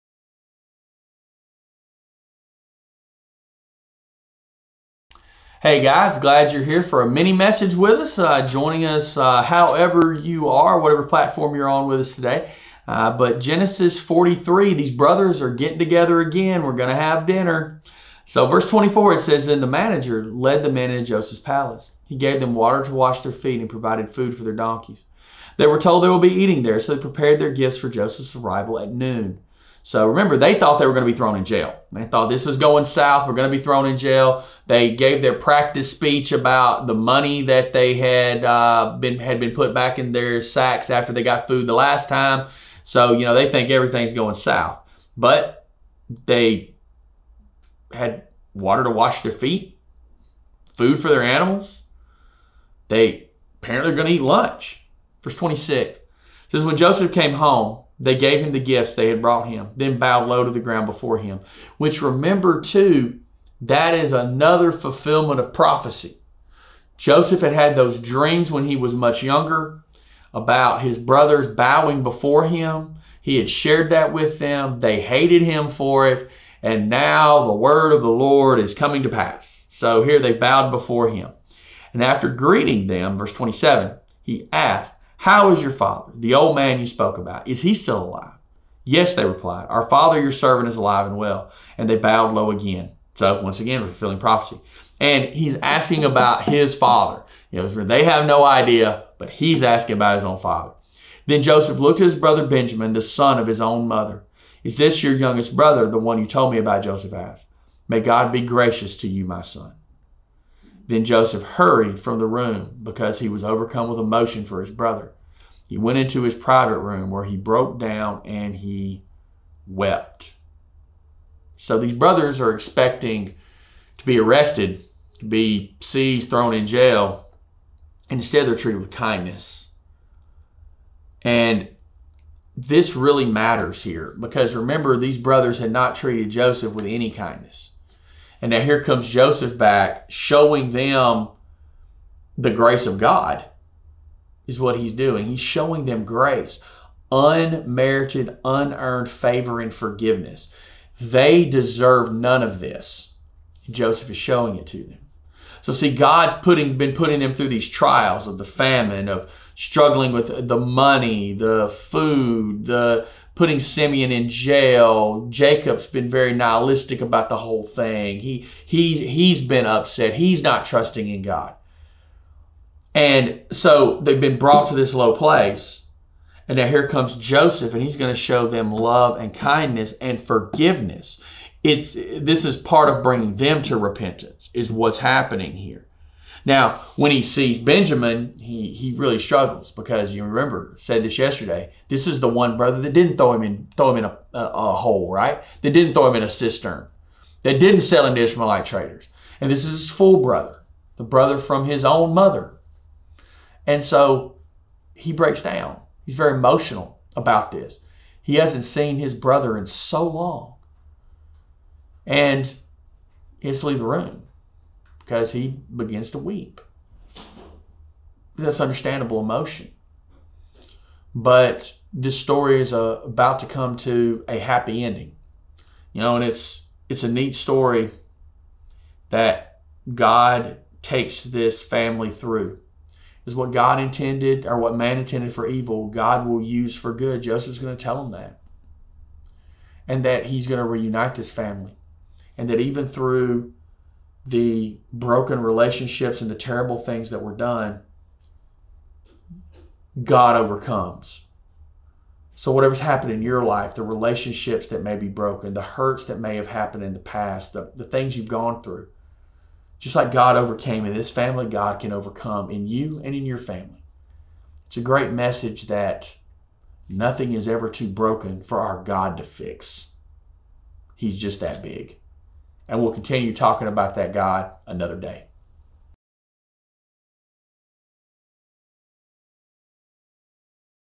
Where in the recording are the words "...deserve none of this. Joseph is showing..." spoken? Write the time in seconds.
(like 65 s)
151 s.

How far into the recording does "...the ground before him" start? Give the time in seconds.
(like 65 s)
60 s.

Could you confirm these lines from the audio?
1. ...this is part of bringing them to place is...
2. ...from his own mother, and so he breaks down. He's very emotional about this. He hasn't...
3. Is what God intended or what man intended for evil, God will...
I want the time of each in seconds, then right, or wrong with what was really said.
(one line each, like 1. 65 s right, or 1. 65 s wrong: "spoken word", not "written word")
1. 181 s wrong: "repentance", not "place"
2. 201 s right
3. 233 s right.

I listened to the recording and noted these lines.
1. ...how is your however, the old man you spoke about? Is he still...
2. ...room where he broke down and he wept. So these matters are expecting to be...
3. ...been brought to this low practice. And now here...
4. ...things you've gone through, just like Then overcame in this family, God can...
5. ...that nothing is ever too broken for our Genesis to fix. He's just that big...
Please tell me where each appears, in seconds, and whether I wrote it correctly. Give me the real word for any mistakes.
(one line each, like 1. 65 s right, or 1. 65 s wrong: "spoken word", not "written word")
1. 85 s wrong: "father", not "however"
2. 116 s wrong: "brothers", not "matters"
3. 174 s wrong: "place", not "practice"
4. 257 s wrong: "God", not "Then"
5. 265 s wrong: "God", not "Genesis".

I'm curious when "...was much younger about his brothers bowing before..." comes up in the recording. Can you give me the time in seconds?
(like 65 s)
68 s.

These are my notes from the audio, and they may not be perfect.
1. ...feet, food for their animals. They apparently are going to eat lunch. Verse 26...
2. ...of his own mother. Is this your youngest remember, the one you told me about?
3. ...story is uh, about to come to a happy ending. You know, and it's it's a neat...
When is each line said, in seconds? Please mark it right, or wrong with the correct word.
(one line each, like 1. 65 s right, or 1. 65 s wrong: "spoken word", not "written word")
1. 49 s right
2. 103 s wrong: "brother", not "remember"
3. 222 s right.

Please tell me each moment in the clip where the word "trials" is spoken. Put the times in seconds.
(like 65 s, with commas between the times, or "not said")
157 s.